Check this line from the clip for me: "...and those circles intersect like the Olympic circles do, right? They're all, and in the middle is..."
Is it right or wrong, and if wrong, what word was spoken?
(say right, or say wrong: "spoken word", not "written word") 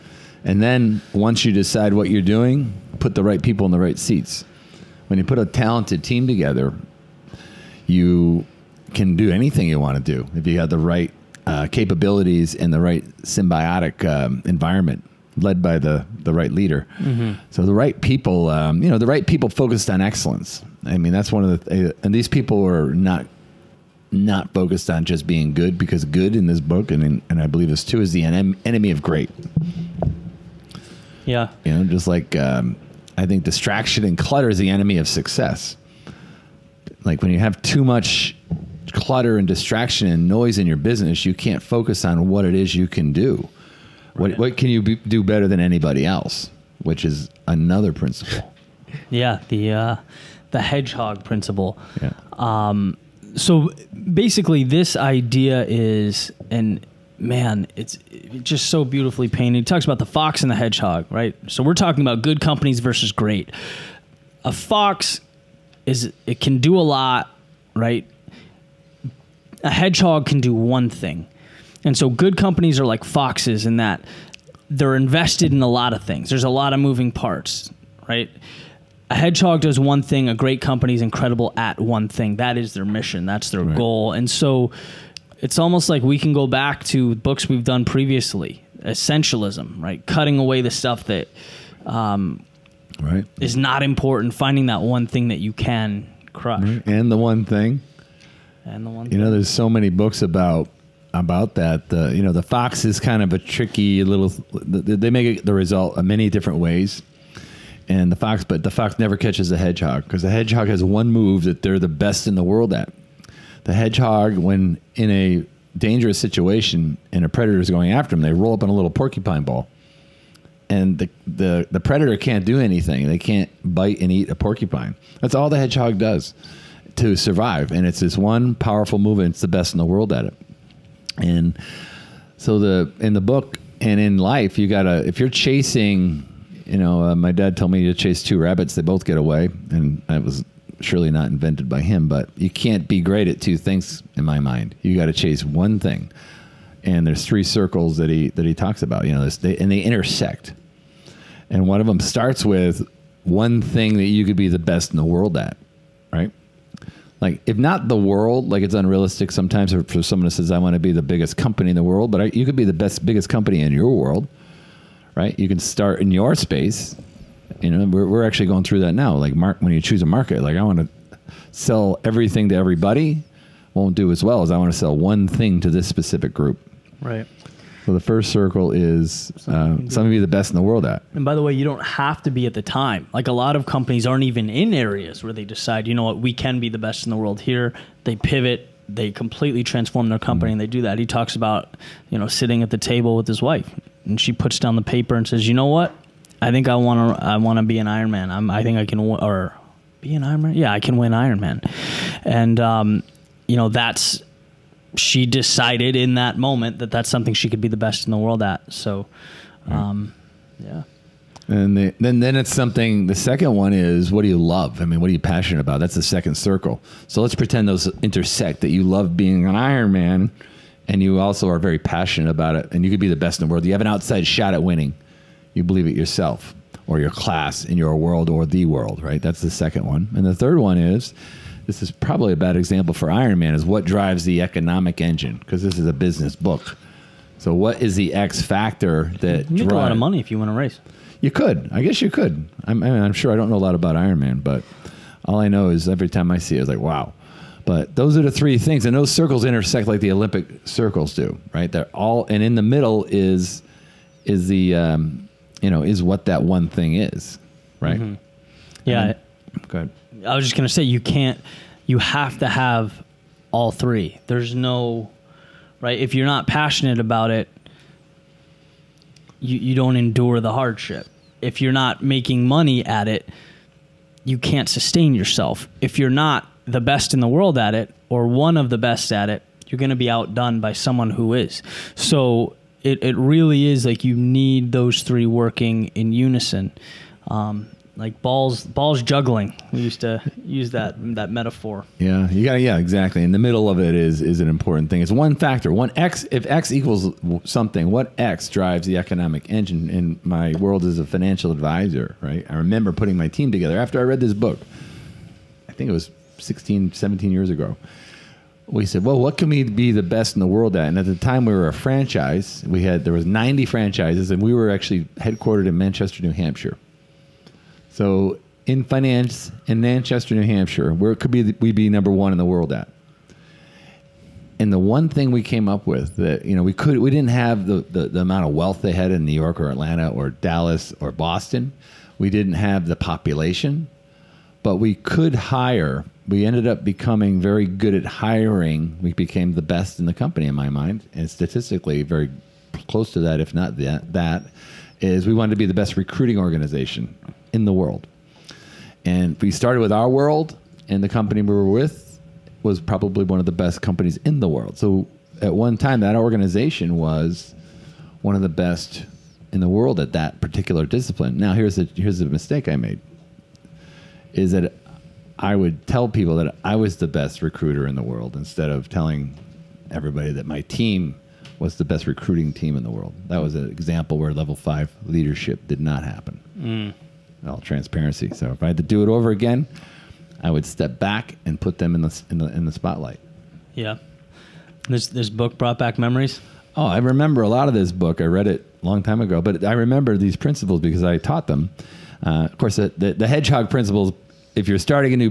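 right.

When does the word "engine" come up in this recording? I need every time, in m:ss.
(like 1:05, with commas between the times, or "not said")
3:54, 4:59.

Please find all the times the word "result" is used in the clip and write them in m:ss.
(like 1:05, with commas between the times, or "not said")
1:45.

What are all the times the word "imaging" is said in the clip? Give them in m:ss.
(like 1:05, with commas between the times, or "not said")
not said.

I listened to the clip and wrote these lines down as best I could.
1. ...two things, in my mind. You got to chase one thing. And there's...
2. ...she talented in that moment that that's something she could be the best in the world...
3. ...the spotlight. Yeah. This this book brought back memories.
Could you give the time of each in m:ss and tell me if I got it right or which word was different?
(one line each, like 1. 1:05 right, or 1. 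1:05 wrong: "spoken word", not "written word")
1. 2:23 right
2. 3:24 wrong: "decided", not "talented"
3. 6:22 right.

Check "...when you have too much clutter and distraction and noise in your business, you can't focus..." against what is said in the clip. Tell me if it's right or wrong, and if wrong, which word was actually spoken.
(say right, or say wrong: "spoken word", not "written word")
right.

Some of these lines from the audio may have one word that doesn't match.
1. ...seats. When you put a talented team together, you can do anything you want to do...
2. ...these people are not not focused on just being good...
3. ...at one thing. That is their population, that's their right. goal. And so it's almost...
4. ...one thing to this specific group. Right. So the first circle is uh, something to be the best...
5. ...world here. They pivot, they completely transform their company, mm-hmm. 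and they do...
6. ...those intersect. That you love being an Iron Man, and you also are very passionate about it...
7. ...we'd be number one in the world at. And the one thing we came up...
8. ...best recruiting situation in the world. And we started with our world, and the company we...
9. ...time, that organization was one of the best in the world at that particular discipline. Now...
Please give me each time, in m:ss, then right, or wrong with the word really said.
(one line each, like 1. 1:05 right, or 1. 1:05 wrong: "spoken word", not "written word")
1. 0:03 right
2. 0:22 right
3. 1:21 wrong: "mission", not "population"
4. 2:54 right
5. 3:07 right
6. 3:37 right
7. 5:21 right
8. 5:45 wrong: "organization", not "situation"
9. 5:55 right.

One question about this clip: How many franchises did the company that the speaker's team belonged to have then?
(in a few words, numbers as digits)
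90.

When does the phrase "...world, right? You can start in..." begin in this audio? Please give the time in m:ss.
2:43.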